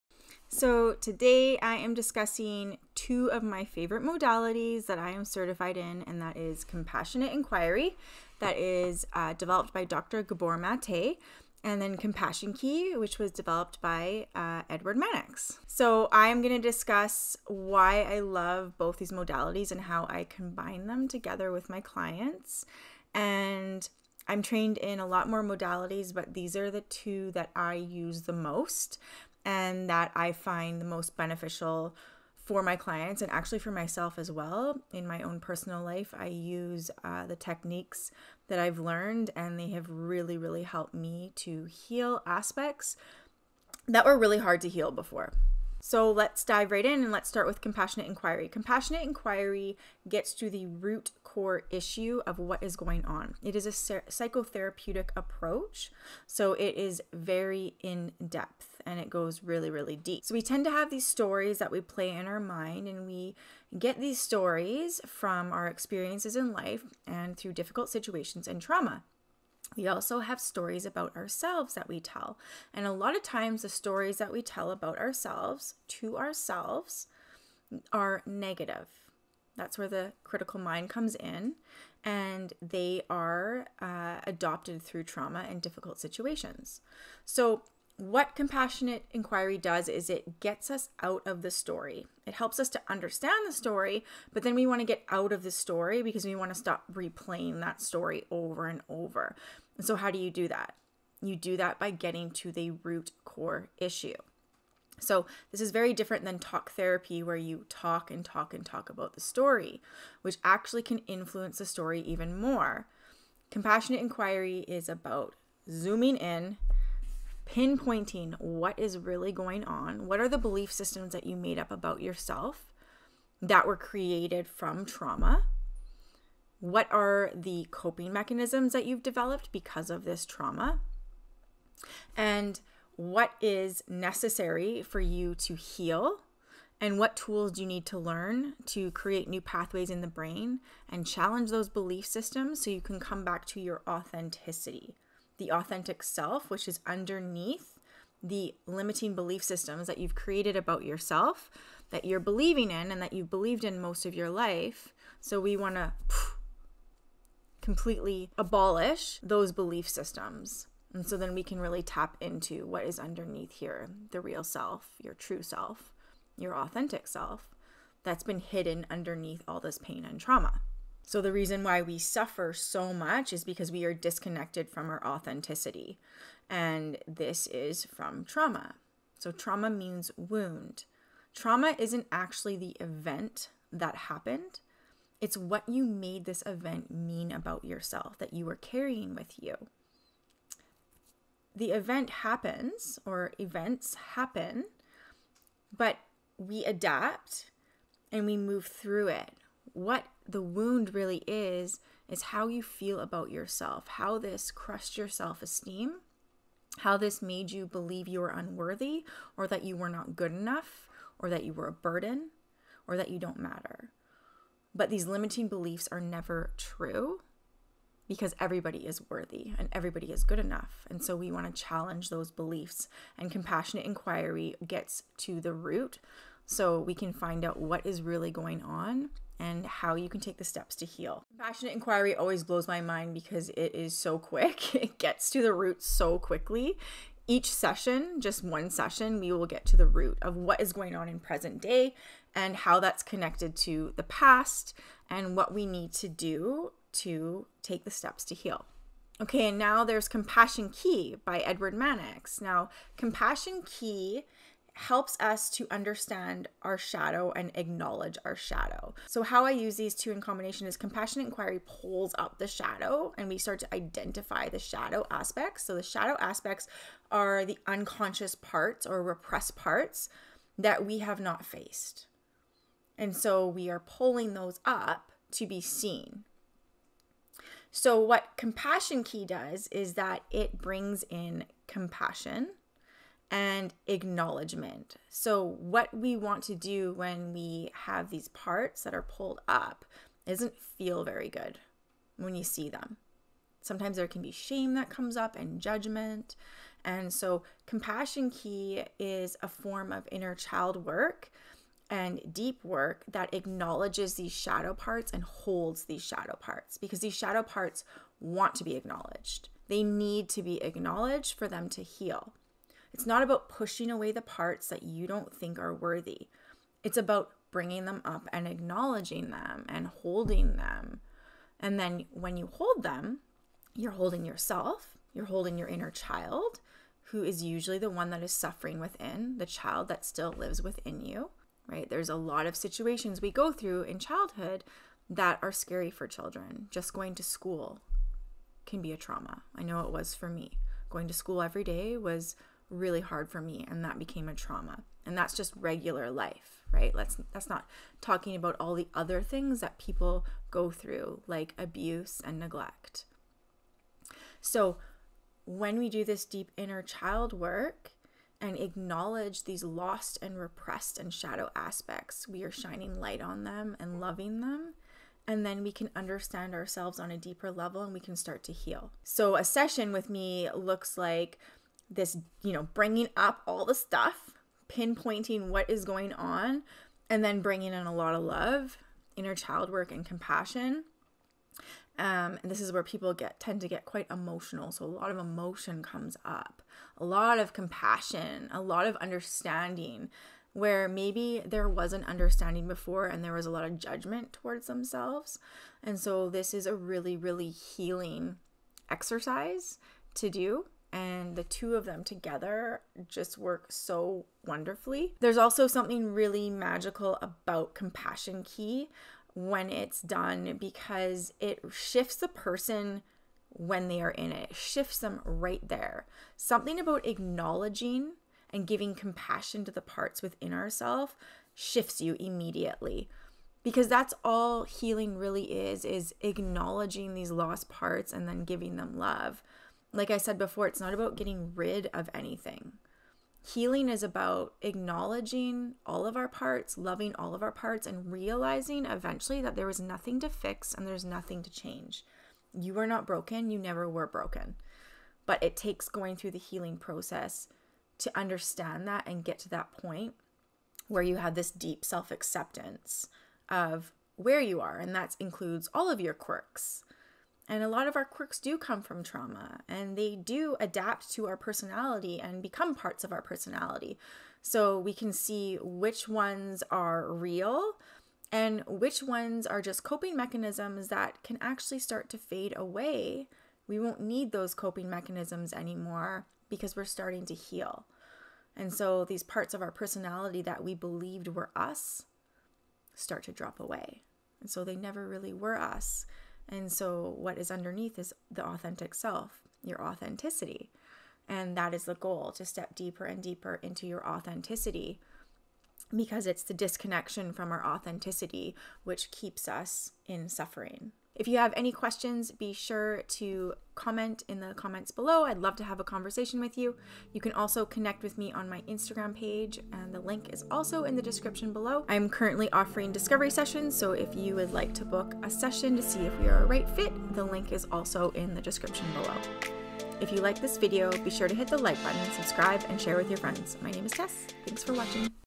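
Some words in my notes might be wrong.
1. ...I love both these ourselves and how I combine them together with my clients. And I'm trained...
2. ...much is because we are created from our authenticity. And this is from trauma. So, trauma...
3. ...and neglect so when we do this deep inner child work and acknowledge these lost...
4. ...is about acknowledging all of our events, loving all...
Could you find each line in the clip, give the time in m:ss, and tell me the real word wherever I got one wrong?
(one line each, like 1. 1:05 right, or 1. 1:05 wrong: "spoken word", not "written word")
1. 0:18 wrong: "modalities", not "ourselves"
2. 2:52 wrong: "disconnected", not "created"
3. 5:52 right
4. 7:13 wrong: "parts", not "events".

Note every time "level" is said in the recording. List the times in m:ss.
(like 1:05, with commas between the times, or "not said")
6:07.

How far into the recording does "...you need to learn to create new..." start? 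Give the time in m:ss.
2:17.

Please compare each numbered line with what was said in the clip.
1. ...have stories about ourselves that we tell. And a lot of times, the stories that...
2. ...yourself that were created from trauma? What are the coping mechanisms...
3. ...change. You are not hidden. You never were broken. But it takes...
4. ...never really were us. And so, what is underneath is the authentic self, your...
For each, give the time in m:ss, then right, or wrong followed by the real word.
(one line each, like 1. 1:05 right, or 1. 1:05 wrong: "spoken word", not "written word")
1. 1:10 right
2. 2:02 right
3. 7:21 wrong: "broken", not "hidden"
4. 8:04 right.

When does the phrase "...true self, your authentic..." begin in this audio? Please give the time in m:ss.
2:45.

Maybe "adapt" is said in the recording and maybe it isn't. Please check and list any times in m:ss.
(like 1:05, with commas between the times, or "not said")
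3:16, 7:40.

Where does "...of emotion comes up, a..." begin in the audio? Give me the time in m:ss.
6:25.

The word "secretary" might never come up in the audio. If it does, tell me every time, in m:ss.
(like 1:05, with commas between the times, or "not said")
not said.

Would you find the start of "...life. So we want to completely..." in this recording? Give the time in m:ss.
2:34.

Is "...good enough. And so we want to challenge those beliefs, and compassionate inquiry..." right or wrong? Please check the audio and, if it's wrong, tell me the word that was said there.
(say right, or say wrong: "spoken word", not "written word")
right.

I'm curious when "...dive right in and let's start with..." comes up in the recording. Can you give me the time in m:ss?
0:46.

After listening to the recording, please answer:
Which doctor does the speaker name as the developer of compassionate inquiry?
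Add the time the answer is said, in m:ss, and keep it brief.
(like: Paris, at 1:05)
Dr. Gabor Mate, at 0:09.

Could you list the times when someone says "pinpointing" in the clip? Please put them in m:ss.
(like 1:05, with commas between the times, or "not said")
1:57, 6:14.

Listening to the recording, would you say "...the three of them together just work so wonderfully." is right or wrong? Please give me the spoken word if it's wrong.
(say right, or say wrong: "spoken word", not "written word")
wrong: "two", not "three".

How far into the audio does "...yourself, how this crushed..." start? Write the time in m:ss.
3:23.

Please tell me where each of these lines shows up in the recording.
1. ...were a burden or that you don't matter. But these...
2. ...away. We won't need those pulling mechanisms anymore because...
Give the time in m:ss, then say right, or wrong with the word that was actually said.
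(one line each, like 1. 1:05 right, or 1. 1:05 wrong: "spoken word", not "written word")
1. 3:31 right
2. 7:52 wrong: "coping", not "pulling".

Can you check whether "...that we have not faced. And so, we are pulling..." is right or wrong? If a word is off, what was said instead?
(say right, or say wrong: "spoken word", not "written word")
right.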